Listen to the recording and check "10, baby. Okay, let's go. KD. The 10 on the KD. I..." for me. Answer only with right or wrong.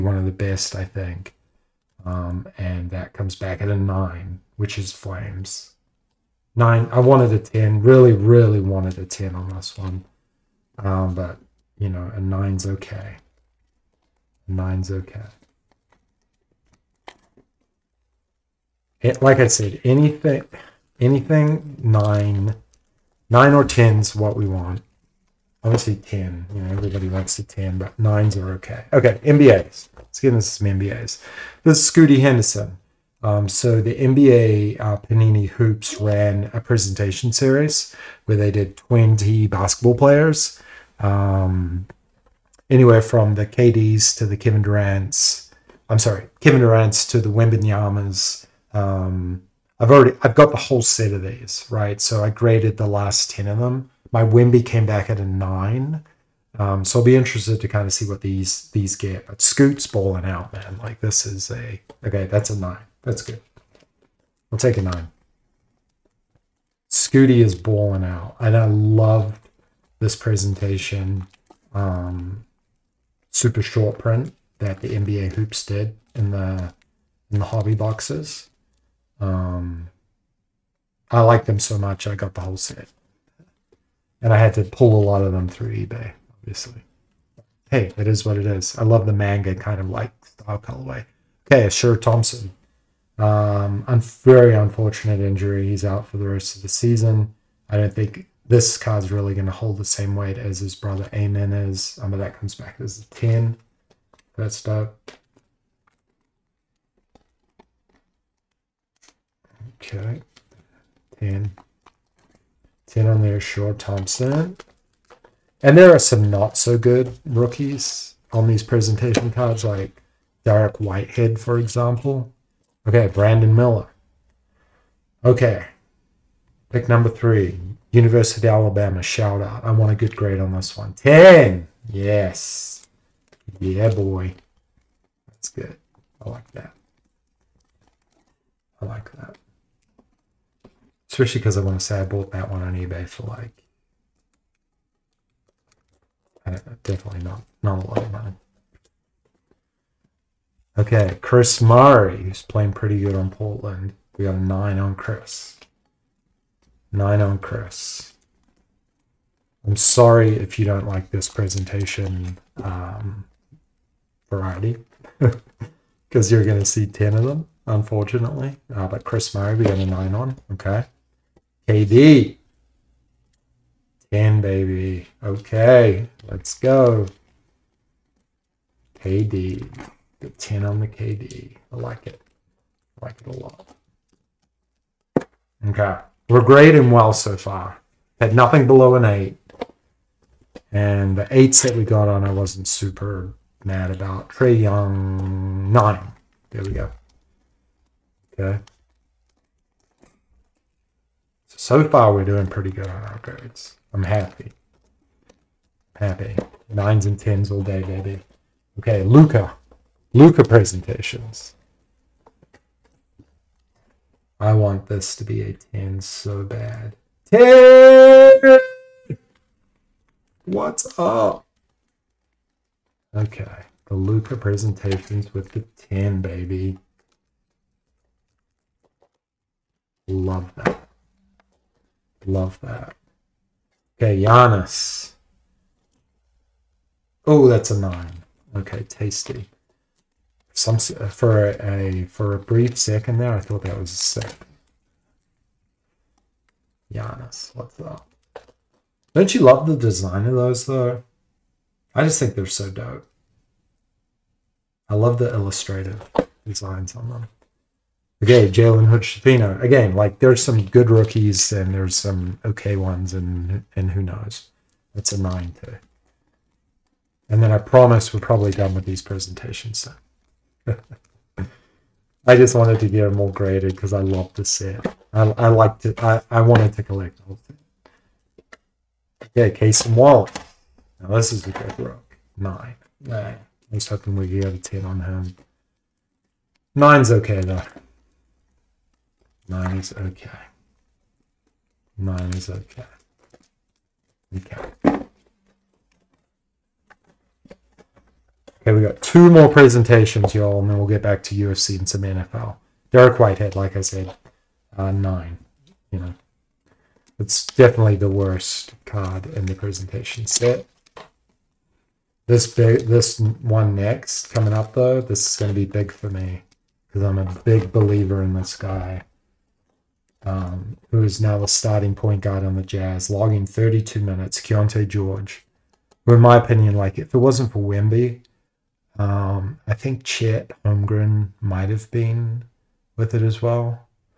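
right.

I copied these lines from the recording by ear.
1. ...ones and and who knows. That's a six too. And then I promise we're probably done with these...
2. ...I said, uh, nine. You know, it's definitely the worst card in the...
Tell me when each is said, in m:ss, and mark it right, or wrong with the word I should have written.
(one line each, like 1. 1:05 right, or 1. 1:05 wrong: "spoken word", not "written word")
1. 4:22 wrong: "nine", not "six"
2. 5:03 right.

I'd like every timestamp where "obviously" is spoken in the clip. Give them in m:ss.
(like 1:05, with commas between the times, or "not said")
0:25, 1:26.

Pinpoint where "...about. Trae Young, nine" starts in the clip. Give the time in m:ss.
3:13.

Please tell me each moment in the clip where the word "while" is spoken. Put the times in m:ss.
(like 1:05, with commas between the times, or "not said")
not said.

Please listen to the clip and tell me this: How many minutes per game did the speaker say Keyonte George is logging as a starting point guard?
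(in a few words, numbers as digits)
32.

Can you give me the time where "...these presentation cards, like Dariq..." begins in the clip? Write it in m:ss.
1:58.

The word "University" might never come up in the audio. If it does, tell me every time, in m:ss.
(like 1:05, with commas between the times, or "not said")
2:07.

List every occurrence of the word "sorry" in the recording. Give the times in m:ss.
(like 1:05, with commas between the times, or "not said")
0:45, 2:39.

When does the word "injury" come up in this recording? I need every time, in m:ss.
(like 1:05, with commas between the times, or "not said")
1:35.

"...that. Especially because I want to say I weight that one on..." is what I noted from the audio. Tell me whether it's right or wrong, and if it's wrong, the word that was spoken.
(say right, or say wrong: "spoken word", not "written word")
wrong: "bought", not "weight".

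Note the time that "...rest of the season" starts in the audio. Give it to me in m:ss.
1:36.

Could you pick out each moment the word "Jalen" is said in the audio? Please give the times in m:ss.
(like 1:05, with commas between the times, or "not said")
4:18.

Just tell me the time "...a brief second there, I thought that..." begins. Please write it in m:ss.
4:02.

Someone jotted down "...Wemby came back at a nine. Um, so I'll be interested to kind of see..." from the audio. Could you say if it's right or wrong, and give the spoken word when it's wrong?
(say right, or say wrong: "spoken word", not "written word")
right.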